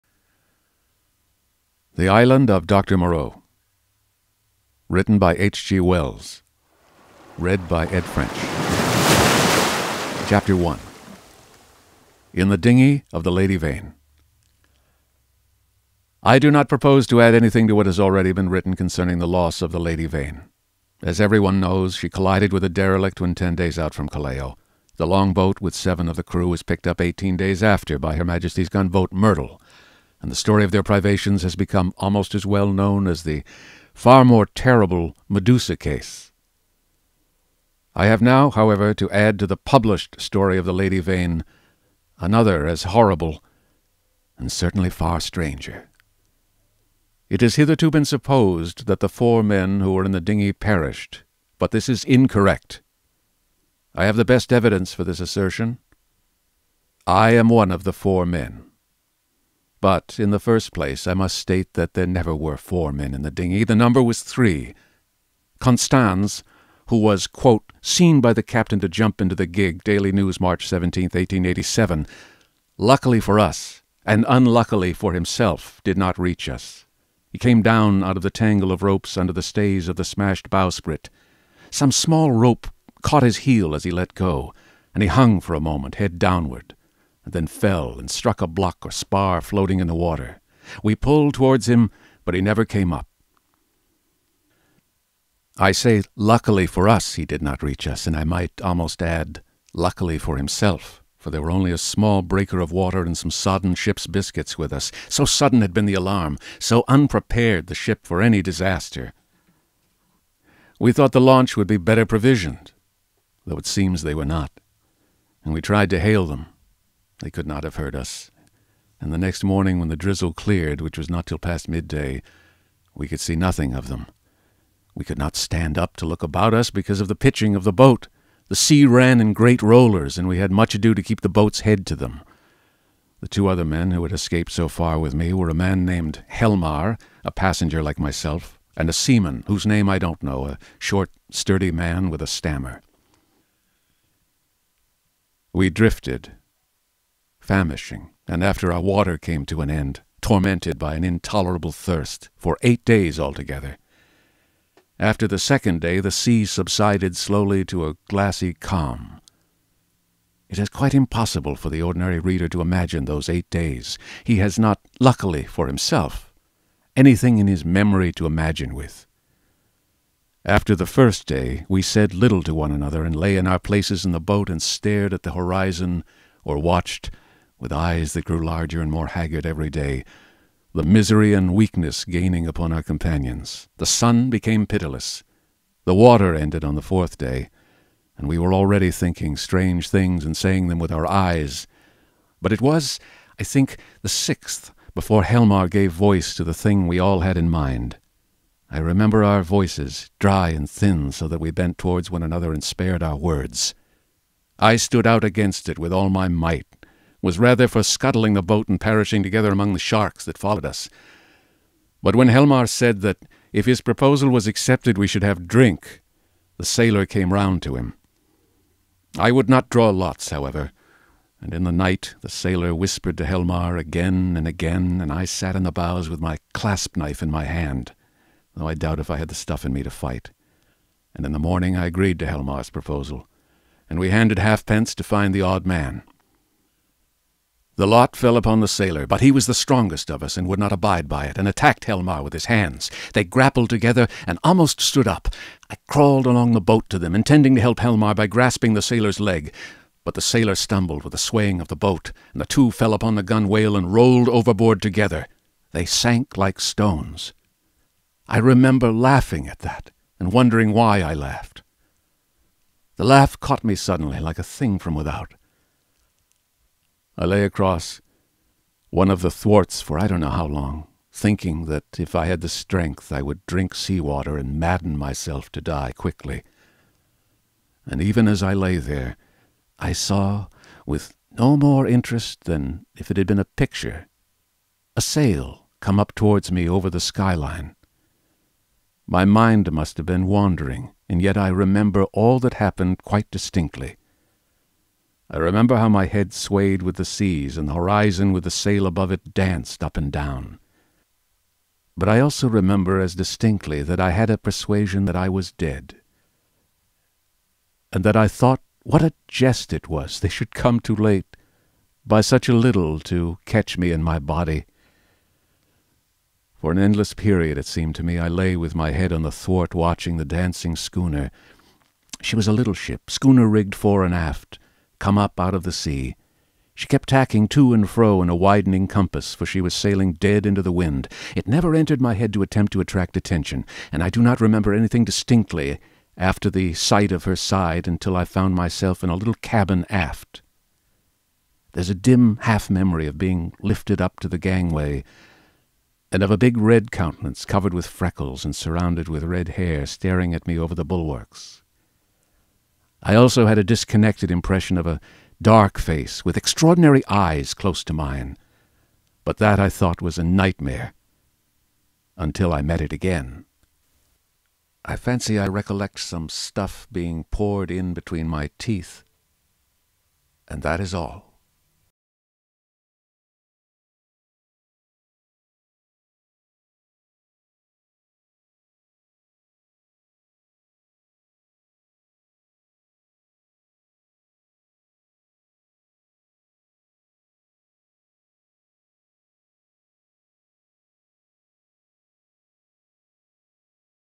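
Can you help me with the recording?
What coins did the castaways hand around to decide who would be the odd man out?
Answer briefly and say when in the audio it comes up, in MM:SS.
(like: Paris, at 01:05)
halfpence, at 03:54.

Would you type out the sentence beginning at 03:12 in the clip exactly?
But it was, I think, the sixth before Helmar gave voice to the thing we all had in mind.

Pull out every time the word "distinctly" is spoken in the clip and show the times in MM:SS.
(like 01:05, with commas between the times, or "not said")
04:53, 05:03, 05:35.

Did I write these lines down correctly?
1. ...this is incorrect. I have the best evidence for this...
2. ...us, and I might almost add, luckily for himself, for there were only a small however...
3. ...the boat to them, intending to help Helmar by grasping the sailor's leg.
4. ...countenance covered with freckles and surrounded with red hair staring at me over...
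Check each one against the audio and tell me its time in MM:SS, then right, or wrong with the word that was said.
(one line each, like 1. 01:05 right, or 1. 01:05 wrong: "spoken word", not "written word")
1. 00:51 right
2. 01:37 wrong: "breaker", not "however"
3. 04:06 right
4. 05:46 right.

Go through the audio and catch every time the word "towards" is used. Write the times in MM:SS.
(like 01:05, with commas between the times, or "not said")
01:31, 03:21, 04:46.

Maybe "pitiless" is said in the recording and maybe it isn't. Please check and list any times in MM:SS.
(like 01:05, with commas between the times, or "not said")
03:04.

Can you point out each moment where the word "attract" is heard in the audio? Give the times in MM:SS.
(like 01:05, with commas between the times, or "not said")
05:32.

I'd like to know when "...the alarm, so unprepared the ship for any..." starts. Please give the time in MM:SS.
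01:45.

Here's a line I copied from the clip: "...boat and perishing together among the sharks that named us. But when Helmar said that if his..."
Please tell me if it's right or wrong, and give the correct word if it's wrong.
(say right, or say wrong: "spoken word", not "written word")
wrong: "followed", not "named".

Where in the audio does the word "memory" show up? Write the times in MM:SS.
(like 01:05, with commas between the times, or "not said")
02:47, 05:42.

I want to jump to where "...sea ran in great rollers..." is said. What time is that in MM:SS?
02:08.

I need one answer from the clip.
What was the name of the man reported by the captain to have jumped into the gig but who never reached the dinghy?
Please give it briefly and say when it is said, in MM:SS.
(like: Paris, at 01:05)
Constans, at 01:05.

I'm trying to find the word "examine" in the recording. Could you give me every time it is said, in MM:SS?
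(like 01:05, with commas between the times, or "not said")
not said.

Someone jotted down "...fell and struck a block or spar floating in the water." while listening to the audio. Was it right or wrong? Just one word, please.
right.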